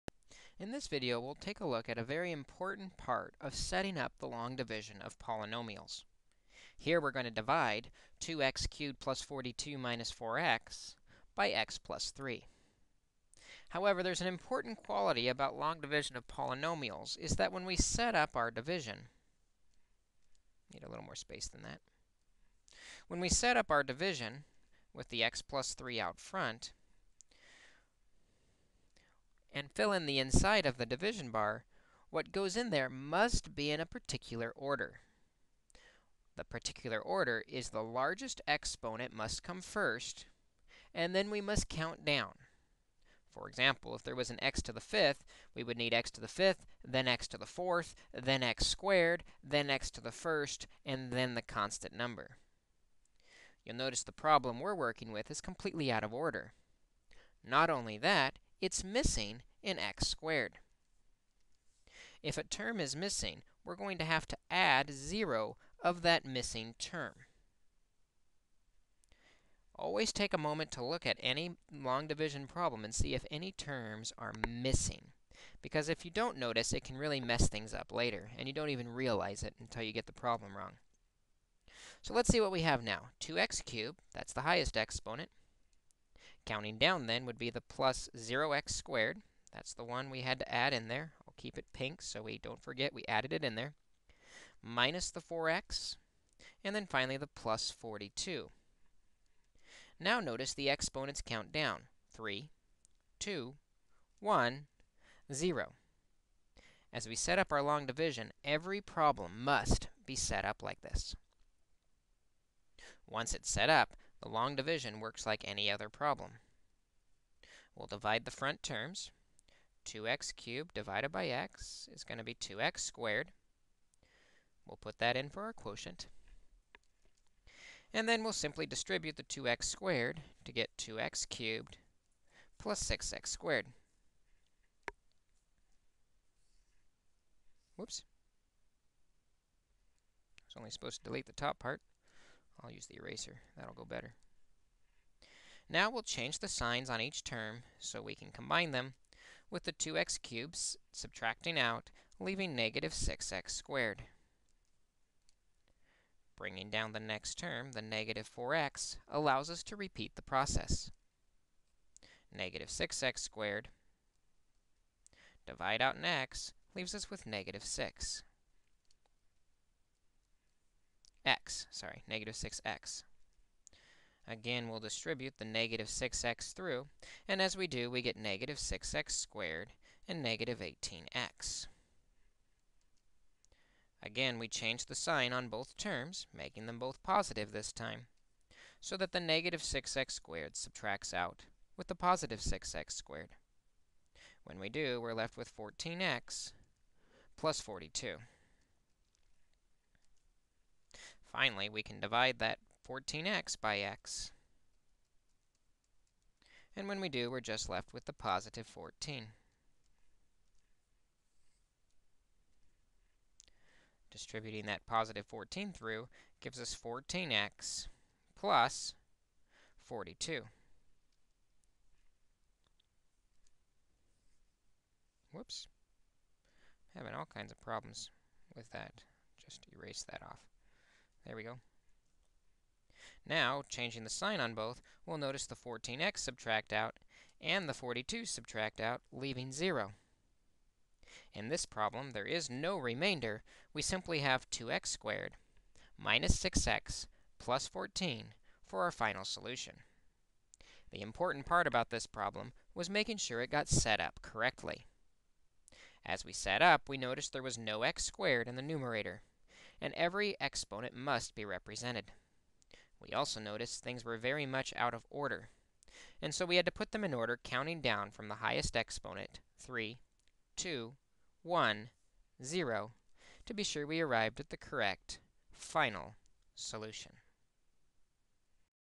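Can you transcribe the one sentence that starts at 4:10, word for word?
The important part about this problem was making sure it got set up correctly.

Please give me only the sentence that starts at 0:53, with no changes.
You'll notice the problem we're working with is completely out of order.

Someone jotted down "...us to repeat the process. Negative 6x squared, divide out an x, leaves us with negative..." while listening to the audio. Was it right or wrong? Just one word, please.
right.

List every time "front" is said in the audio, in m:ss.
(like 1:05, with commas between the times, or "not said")
0:26, 1:58.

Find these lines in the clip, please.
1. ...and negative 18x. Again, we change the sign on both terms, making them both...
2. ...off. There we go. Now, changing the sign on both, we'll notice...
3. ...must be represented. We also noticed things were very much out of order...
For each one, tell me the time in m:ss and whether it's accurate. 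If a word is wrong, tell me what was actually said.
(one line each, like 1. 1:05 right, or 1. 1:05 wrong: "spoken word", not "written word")
1. 3:00 right
2. 3:50 right
3. 4:20 right.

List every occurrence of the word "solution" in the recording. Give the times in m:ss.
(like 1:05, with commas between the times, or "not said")
4:09, 4:36.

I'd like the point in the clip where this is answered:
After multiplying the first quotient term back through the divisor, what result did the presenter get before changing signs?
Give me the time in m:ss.
2:10.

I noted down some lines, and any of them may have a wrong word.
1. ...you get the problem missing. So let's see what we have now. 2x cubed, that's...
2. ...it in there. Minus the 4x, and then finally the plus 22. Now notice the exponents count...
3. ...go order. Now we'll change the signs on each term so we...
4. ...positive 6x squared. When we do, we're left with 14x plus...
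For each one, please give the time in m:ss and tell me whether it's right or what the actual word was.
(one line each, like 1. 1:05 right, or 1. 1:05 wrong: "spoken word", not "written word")
1. 1:19 wrong: "wrong", not "missing"
2. 1:33 wrong: "42", not "22"
3. 2:23 wrong: "better", not "order"
4. 3:11 right.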